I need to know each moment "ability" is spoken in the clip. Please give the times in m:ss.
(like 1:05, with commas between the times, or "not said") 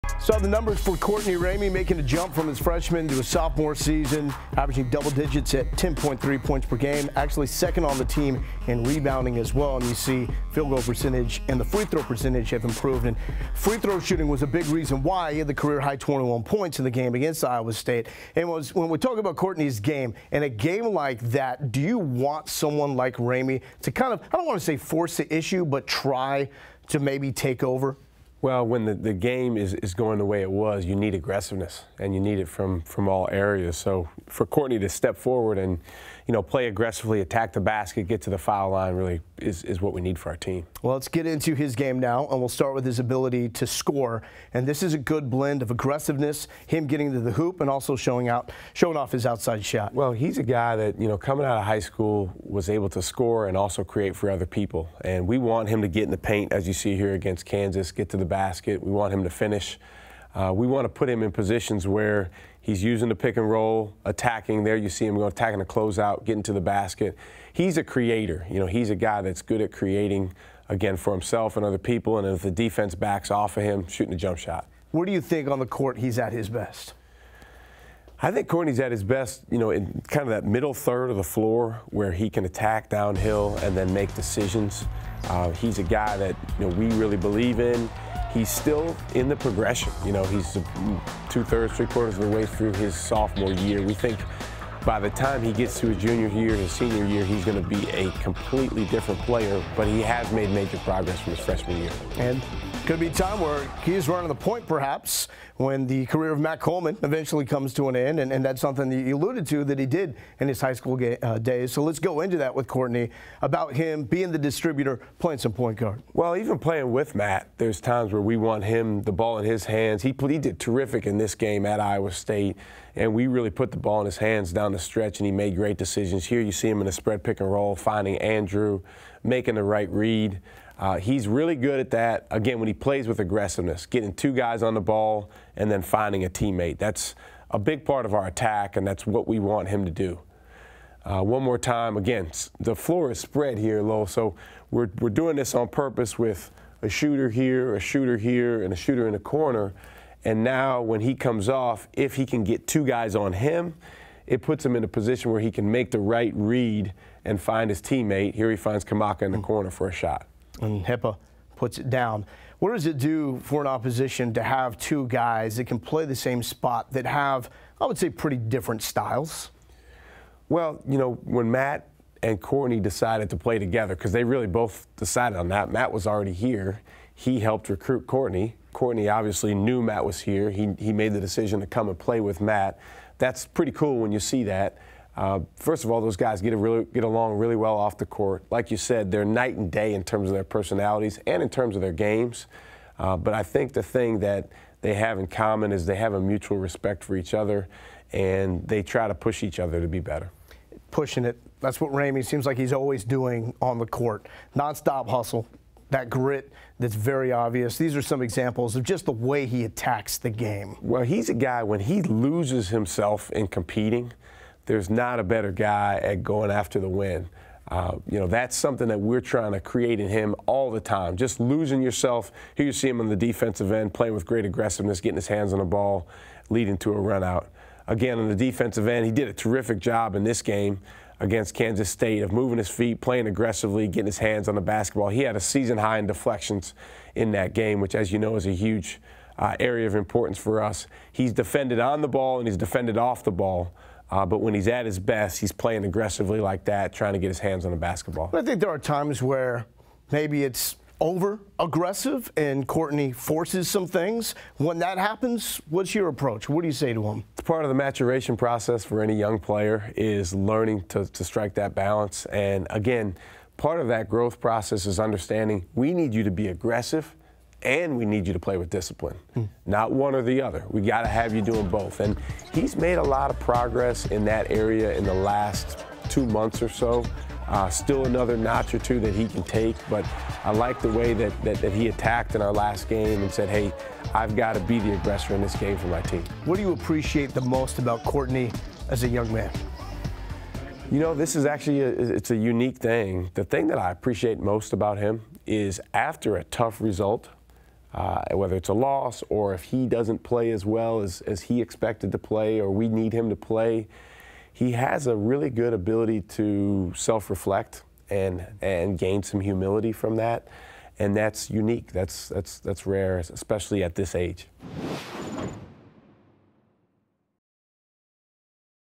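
0:42, 5:05.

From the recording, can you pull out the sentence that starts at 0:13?
And free throw shooting was a big reason why he had the career high 21 points in the game against Iowa State.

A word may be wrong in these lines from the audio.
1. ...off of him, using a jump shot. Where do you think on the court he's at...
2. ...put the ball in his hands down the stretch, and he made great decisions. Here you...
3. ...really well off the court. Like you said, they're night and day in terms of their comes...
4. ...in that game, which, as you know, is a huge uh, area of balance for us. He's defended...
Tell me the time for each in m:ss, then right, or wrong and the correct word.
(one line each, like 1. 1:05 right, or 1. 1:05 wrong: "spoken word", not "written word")
1. 1:13 wrong: "shooting", not "using"
2. 2:03 right
3. 3:07 wrong: "personalities", not "comes"
4. 3:57 wrong: "importance", not "balance".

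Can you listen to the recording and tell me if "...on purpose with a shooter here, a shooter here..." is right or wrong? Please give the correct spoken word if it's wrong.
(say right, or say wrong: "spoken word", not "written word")
right.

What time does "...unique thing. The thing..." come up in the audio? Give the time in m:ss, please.
4:52.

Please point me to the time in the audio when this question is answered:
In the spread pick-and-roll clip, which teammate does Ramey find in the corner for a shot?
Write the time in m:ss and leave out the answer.
2:38.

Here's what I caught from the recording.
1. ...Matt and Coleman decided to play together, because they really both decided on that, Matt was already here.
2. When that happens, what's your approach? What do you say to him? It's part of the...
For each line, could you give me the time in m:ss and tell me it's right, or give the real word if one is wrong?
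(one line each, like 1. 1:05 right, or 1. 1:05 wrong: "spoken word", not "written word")
1. 2:51 wrong: "Courtney", not "Coleman"
2. 4:14 right.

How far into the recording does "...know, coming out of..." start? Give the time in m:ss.
0:51.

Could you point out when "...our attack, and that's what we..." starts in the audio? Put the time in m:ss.
2:18.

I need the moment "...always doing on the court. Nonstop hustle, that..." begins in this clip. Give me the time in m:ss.
3:22.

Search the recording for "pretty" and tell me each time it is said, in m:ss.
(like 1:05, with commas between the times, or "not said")
2:48, 3:03.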